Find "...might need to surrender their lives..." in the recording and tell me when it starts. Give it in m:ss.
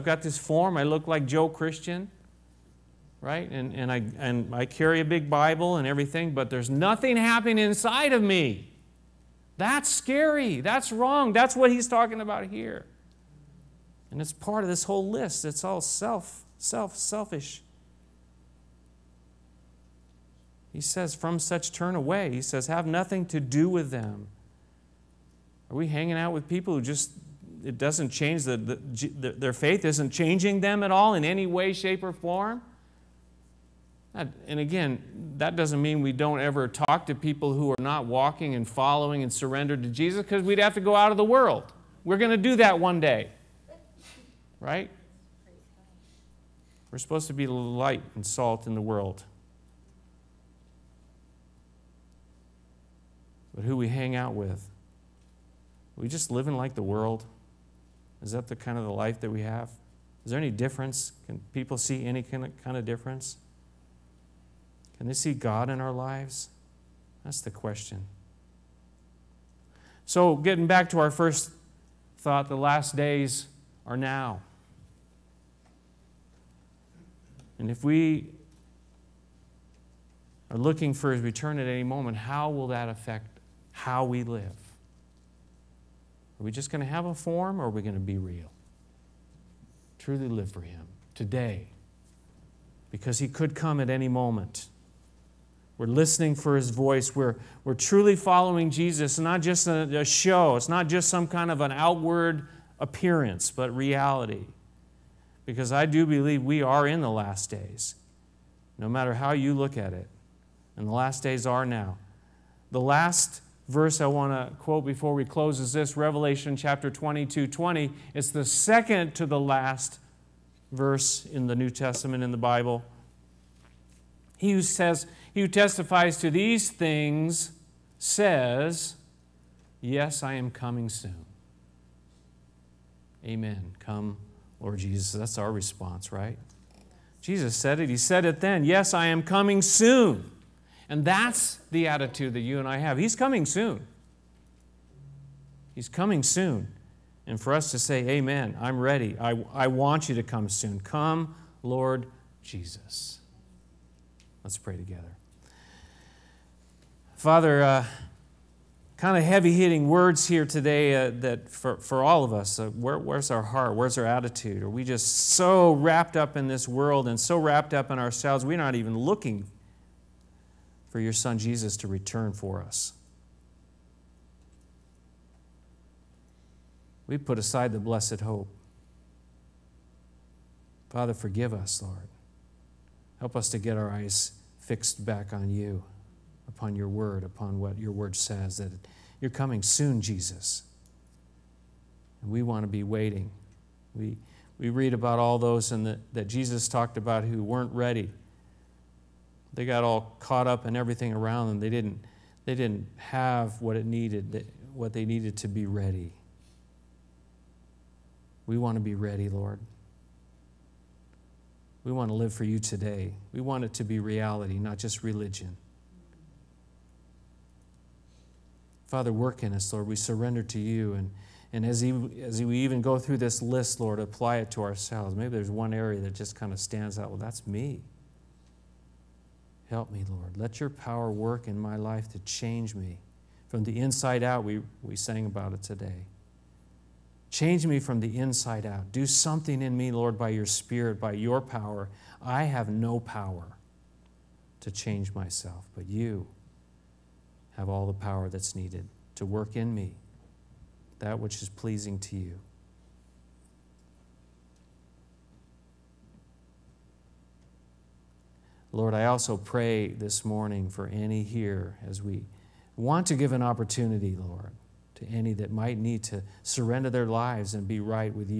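4:25.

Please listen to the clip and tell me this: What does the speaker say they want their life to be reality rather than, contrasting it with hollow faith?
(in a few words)
religion.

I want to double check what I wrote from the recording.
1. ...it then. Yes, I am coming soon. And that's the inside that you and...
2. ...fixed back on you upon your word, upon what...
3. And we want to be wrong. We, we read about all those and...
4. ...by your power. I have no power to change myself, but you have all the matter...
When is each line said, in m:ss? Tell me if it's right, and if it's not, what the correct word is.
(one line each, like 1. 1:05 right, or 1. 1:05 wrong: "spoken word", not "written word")
1. 2:18 wrong: "attitude", not "inside"
2. 3:04 right
3. 3:12 wrong: "waiting", not "wrong"
4. 4:00 wrong: "power", not "matter".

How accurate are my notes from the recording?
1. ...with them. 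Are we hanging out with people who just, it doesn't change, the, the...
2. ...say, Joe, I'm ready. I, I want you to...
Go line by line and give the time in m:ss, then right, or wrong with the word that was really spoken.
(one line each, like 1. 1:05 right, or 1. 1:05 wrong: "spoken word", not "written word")
1. 0:23 right
2. 2:27 wrong: "Amen", not "Joe".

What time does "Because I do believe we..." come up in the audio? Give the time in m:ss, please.
1:45.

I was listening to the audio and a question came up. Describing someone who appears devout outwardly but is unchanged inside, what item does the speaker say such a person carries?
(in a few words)
a big Bible.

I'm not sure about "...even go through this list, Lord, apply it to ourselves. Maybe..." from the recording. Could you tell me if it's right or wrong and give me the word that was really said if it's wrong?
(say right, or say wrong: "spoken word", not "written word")
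right.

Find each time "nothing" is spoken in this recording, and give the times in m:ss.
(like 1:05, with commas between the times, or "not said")
0:06, 0:22.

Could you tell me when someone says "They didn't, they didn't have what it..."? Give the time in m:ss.
3:21.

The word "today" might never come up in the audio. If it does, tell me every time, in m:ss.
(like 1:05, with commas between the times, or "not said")
1:31, 2:40, 3:32, 3:55.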